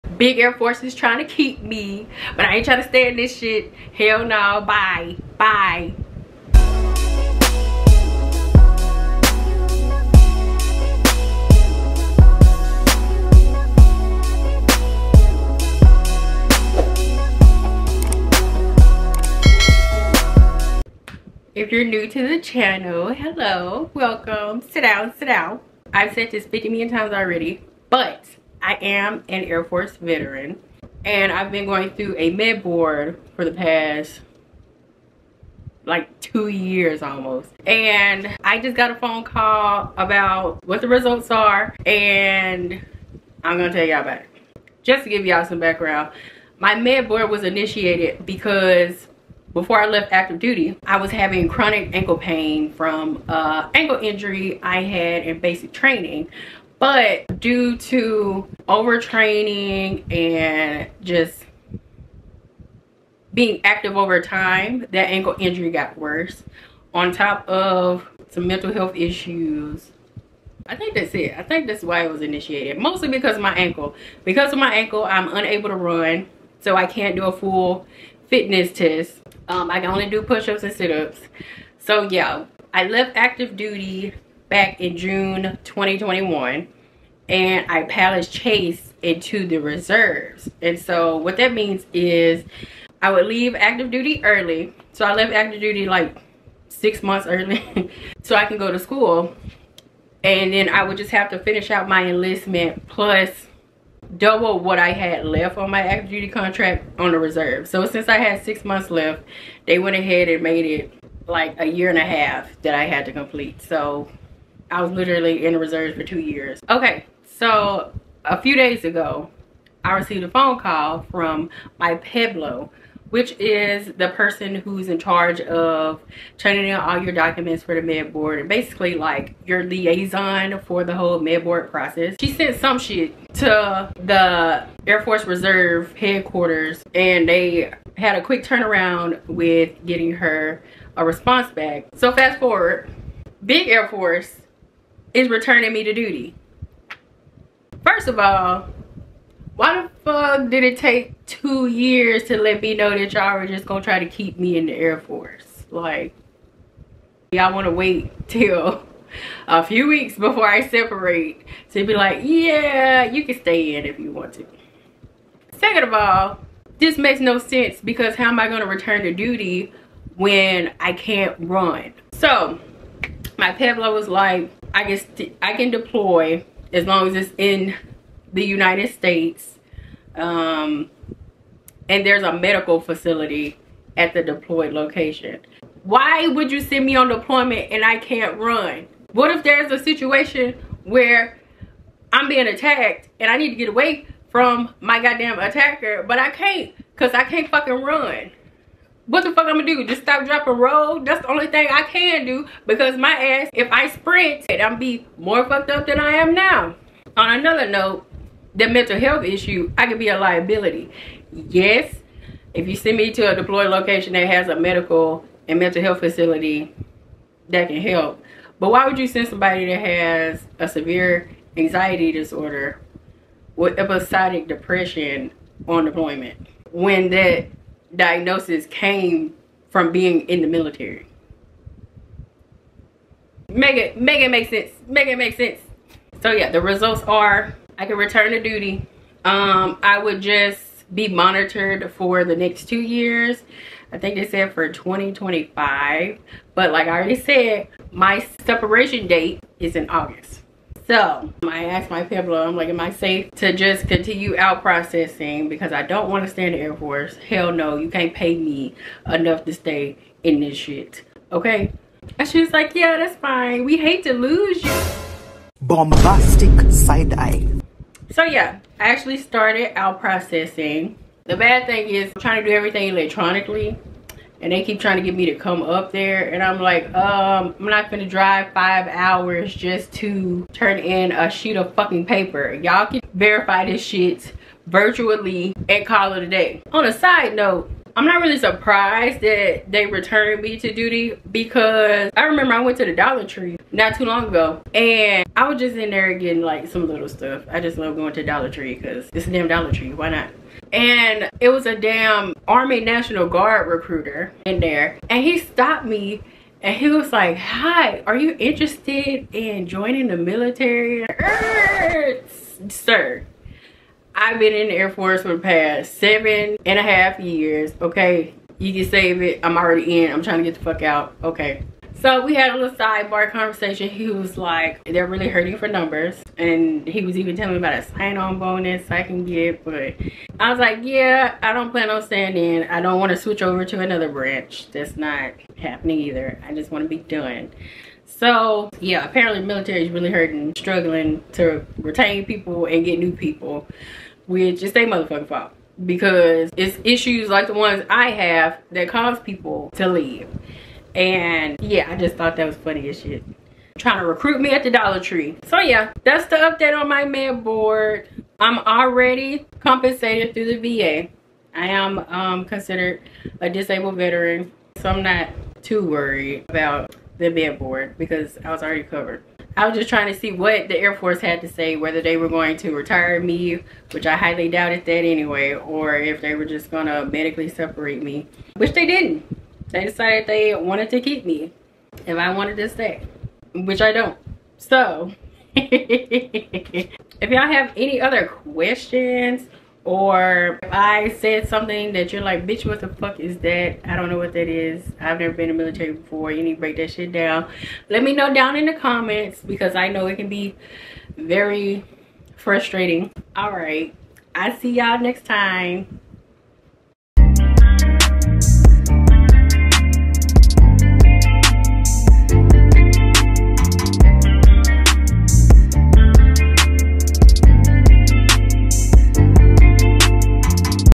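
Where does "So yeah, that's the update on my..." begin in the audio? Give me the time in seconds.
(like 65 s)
355 s.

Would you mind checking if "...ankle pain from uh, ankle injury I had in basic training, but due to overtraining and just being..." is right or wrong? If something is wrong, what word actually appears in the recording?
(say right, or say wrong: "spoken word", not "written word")
right.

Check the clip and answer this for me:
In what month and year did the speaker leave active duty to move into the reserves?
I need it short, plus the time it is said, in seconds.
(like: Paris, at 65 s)
June 2021, at 84 s.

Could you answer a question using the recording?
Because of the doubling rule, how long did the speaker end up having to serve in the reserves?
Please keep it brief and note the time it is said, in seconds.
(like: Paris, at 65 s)
a year and a half, at 111 s.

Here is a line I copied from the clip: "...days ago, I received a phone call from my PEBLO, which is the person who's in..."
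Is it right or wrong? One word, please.
right.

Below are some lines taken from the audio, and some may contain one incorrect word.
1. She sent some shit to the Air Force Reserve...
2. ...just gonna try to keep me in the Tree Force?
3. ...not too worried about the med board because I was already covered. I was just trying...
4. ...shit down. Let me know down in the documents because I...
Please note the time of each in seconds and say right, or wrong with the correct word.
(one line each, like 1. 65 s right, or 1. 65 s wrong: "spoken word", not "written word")
1. 132 s right
2. 153 s wrong: "Air", not "Tree"
3. 365 s right
4. 396 s wrong: "comments", not "documents".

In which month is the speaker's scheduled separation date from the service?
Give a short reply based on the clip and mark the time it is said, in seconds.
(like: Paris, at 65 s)
August, at 249 s.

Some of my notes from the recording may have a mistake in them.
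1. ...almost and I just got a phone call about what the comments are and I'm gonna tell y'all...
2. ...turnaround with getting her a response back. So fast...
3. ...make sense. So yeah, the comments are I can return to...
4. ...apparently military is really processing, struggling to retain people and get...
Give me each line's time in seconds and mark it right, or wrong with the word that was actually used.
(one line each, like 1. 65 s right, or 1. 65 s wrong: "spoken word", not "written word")
1. 37 s wrong: "results", not "comments"
2. 138 s right
3. 235 s wrong: "results", not "comments"
4. 339 s wrong: "hurting", not "processing".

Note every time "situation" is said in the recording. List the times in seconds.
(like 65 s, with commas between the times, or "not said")
189 s.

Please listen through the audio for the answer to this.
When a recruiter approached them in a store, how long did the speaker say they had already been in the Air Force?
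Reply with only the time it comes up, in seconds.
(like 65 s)
315 s.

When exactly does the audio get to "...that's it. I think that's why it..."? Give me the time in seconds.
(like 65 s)
70 s.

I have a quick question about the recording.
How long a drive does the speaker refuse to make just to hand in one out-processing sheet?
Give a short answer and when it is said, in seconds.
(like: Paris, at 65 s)
5 hours, at 278 s.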